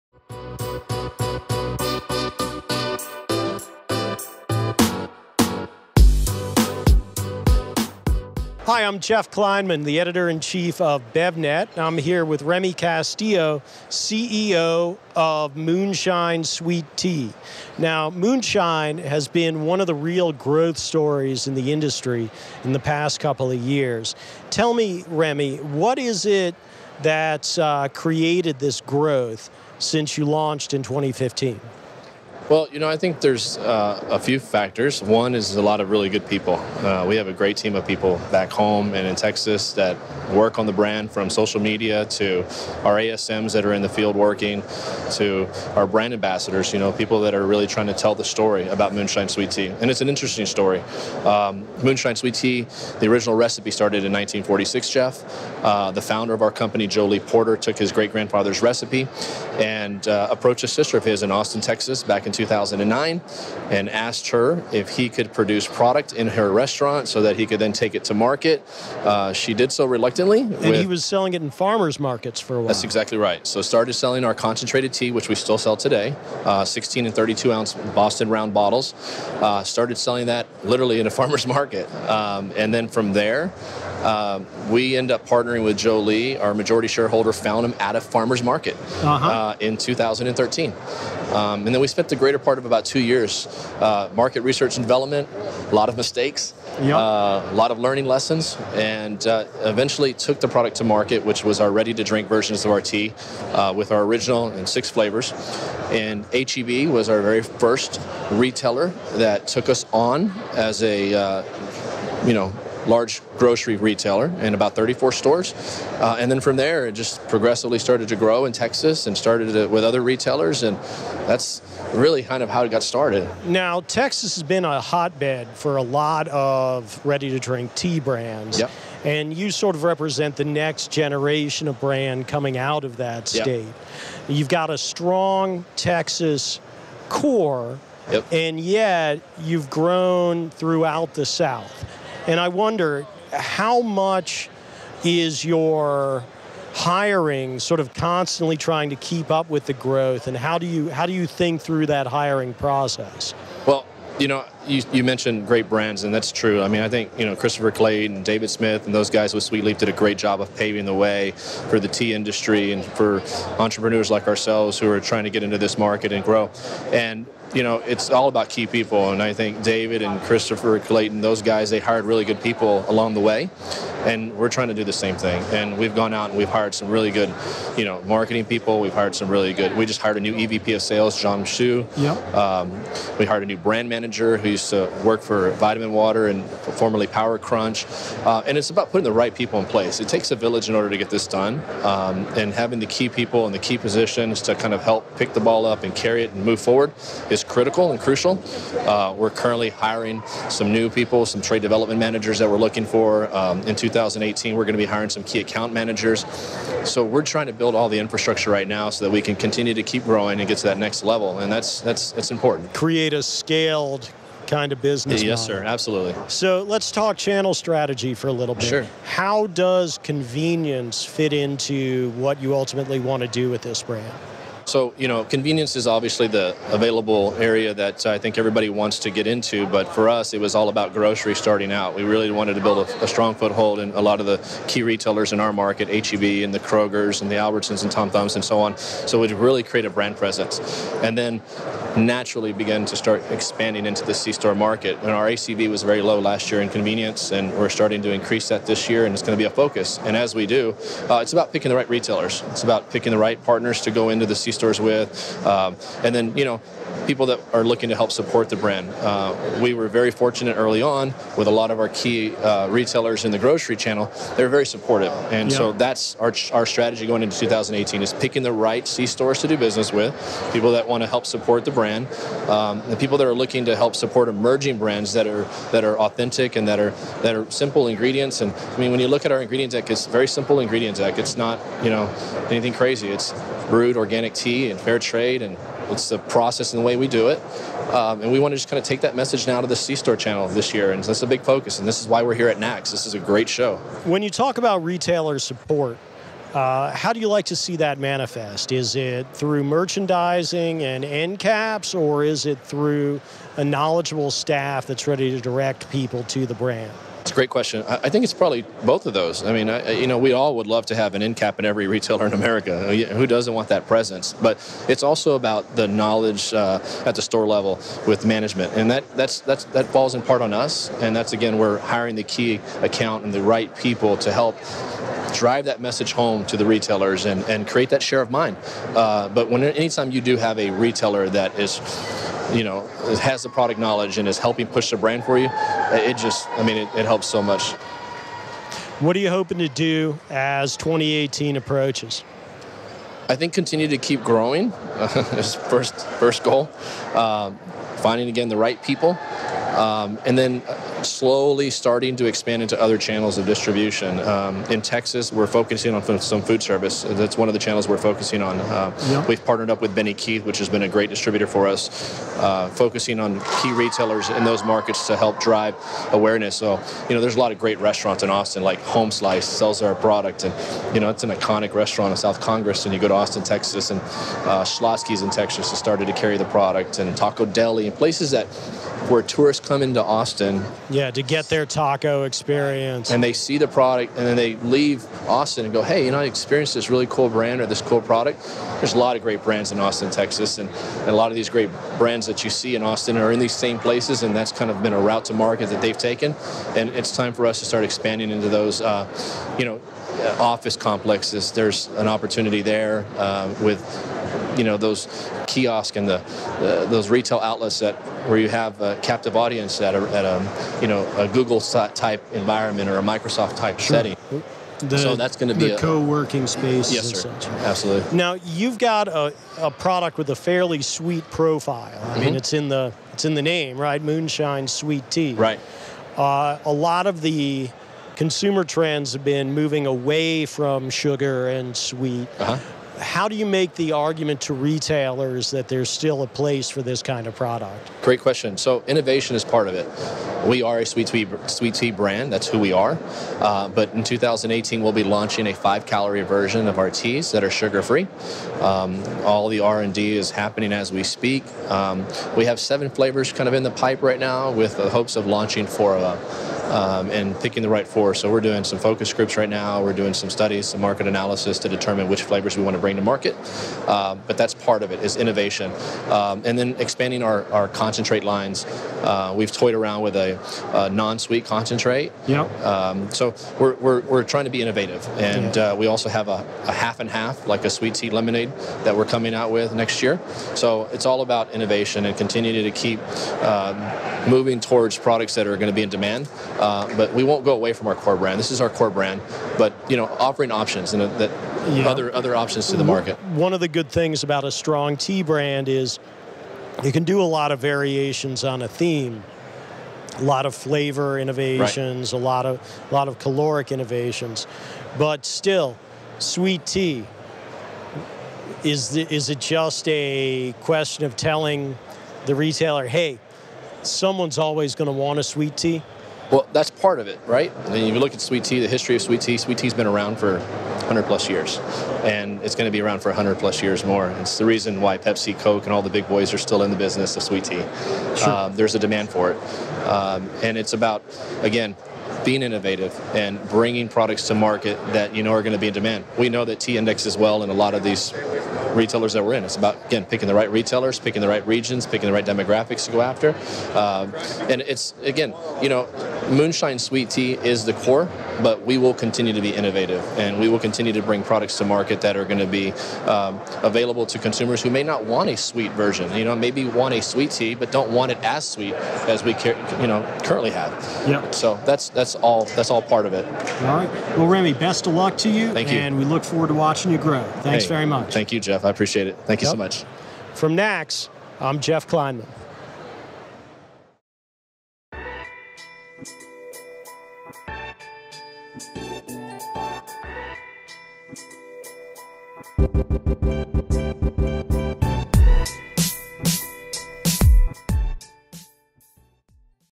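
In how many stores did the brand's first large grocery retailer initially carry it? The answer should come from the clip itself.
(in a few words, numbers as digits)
34.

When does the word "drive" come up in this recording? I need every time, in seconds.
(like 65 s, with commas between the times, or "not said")
325 s, 365 s.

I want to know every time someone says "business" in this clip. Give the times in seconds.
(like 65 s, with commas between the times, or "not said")
214 s, 269 s, 526 s.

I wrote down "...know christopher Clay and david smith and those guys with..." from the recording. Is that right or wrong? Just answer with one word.
right.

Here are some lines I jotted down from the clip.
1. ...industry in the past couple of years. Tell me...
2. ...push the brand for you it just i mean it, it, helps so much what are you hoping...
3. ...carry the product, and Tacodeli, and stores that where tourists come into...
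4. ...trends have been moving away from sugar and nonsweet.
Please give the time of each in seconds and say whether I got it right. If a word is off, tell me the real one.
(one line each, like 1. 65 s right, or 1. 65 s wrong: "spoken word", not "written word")
1. 21 s right
2. 334 s right
3. 376 s wrong: "places", not "stores"
4. 428 s wrong: "sweet", not "nonsweet".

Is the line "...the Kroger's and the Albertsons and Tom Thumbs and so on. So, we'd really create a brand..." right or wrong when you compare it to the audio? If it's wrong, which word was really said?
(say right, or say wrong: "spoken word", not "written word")
right.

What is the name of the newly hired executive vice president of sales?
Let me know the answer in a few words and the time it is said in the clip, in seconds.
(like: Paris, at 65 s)
John Shu, at 181 s.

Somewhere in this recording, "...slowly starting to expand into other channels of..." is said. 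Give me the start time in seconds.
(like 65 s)
351 s.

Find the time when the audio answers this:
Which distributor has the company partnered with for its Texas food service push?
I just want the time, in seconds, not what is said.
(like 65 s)
359 s.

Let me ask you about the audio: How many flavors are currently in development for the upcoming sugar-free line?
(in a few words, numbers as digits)
7.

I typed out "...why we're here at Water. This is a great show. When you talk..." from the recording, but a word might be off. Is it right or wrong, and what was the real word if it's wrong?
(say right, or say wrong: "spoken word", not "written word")
wrong: "NACS", not "Water".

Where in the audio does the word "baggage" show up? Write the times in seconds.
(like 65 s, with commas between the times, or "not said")
not said.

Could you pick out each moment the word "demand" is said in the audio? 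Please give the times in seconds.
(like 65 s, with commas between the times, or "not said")
485 s, 528 s, 535 s.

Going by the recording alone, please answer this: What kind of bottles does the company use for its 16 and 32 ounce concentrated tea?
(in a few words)
Boston round bottles.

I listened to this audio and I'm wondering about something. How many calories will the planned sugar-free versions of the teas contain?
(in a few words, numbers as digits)
5.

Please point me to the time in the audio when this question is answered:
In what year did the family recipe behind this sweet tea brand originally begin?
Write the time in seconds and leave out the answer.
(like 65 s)
54 s.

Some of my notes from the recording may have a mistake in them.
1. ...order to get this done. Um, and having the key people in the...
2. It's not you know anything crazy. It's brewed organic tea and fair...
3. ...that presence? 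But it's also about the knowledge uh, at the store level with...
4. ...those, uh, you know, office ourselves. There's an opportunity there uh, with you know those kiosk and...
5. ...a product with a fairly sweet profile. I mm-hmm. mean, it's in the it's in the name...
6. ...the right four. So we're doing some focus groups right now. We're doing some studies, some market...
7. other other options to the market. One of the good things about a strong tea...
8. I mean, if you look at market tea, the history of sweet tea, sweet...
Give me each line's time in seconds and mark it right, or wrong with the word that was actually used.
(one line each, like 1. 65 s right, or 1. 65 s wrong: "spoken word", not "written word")
1. 190 s right
2. 281 s right
3. 313 s right
4. 398 s wrong: "complexes", not "ourselves"
5. 419 s right
6. 457 s right
7. 491 s right
8. 517 s wrong: "sweet", not "market".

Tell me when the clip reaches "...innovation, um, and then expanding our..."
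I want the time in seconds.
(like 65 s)
465 s.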